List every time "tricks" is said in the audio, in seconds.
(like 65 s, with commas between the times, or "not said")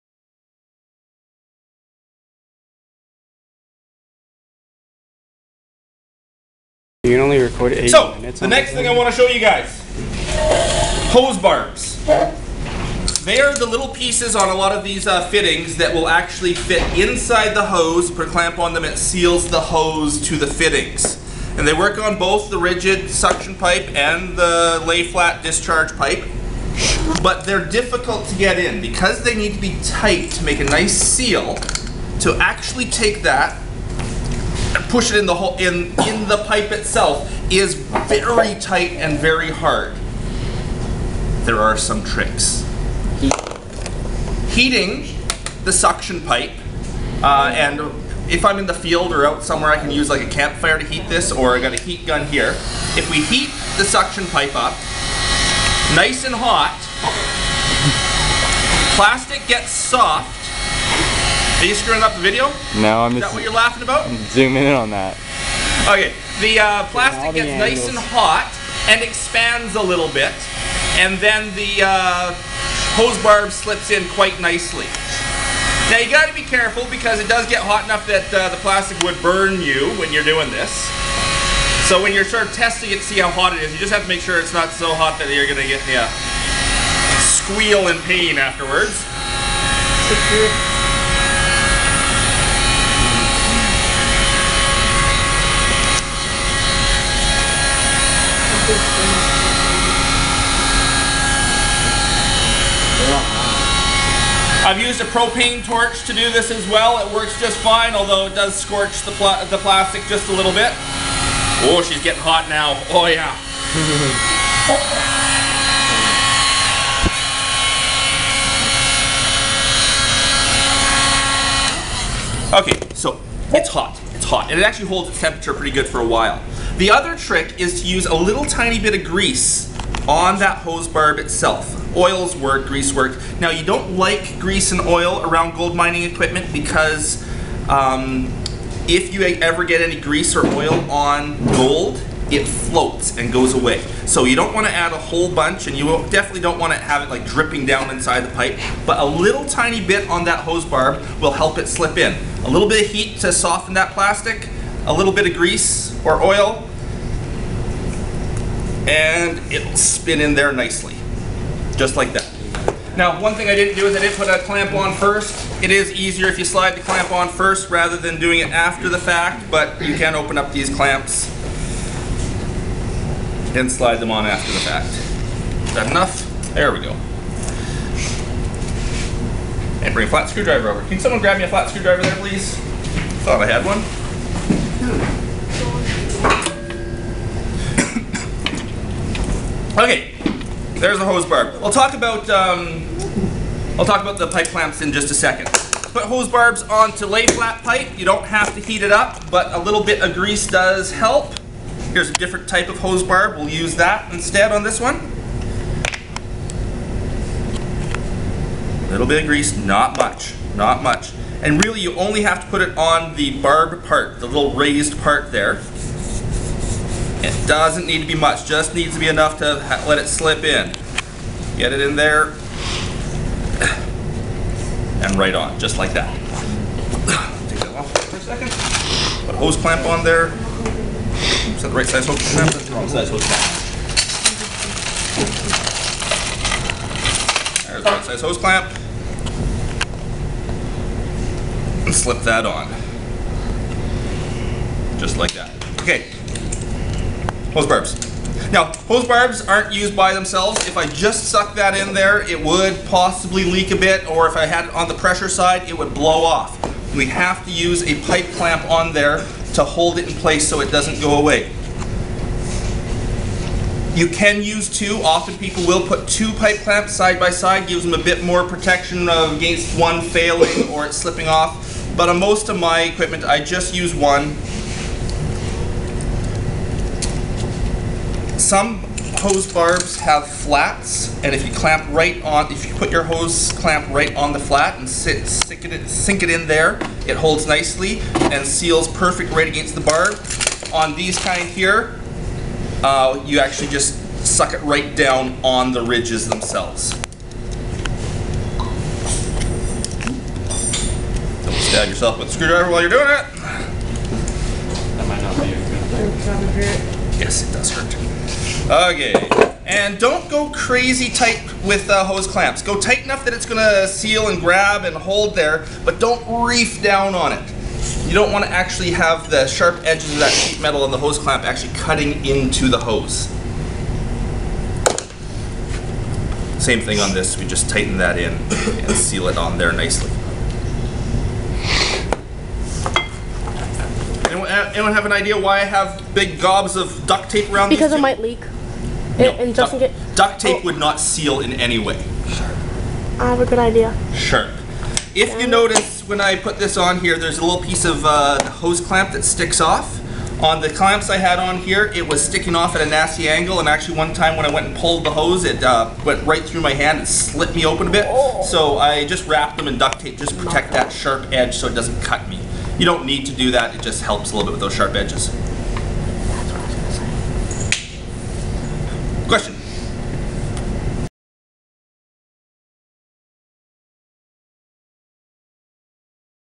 42 s, 127 s.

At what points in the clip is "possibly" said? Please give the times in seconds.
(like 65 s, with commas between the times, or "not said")
252 s.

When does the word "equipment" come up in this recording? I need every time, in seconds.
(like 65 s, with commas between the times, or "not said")
136 s, 272 s.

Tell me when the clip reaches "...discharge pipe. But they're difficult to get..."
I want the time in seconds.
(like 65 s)
25 s.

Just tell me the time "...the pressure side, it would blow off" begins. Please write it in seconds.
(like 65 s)
254 s.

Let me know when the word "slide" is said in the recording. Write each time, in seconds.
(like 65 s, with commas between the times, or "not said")
166 s, 173 s.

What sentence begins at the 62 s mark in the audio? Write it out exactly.
No, I'm Is that what you're laughing about?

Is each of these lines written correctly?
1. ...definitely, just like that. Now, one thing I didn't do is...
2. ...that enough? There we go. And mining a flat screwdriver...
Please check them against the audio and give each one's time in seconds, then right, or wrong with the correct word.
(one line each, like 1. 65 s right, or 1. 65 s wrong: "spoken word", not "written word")
1. 160 s wrong: "nicely", not "definitely"
2. 175 s wrong: "bring", not "mining".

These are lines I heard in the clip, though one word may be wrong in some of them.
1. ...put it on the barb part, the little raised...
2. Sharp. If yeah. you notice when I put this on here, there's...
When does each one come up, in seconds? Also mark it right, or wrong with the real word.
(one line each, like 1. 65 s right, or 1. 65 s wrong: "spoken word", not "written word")
1. 212 s right
2. 344 s right.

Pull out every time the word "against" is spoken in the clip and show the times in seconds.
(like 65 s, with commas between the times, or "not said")
269 s, 289 s.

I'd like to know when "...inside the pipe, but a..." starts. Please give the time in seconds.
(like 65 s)
147 s.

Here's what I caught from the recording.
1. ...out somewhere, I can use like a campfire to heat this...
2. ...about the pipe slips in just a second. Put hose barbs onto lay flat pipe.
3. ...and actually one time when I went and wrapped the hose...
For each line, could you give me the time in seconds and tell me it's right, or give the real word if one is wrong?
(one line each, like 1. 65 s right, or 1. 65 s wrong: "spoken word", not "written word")
1. 49 s right
2. 194 s wrong: "clamps", not "slips"
3. 353 s wrong: "pulled", not "wrapped".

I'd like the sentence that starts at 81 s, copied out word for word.
So when you're sort of testing it, see how hot it is.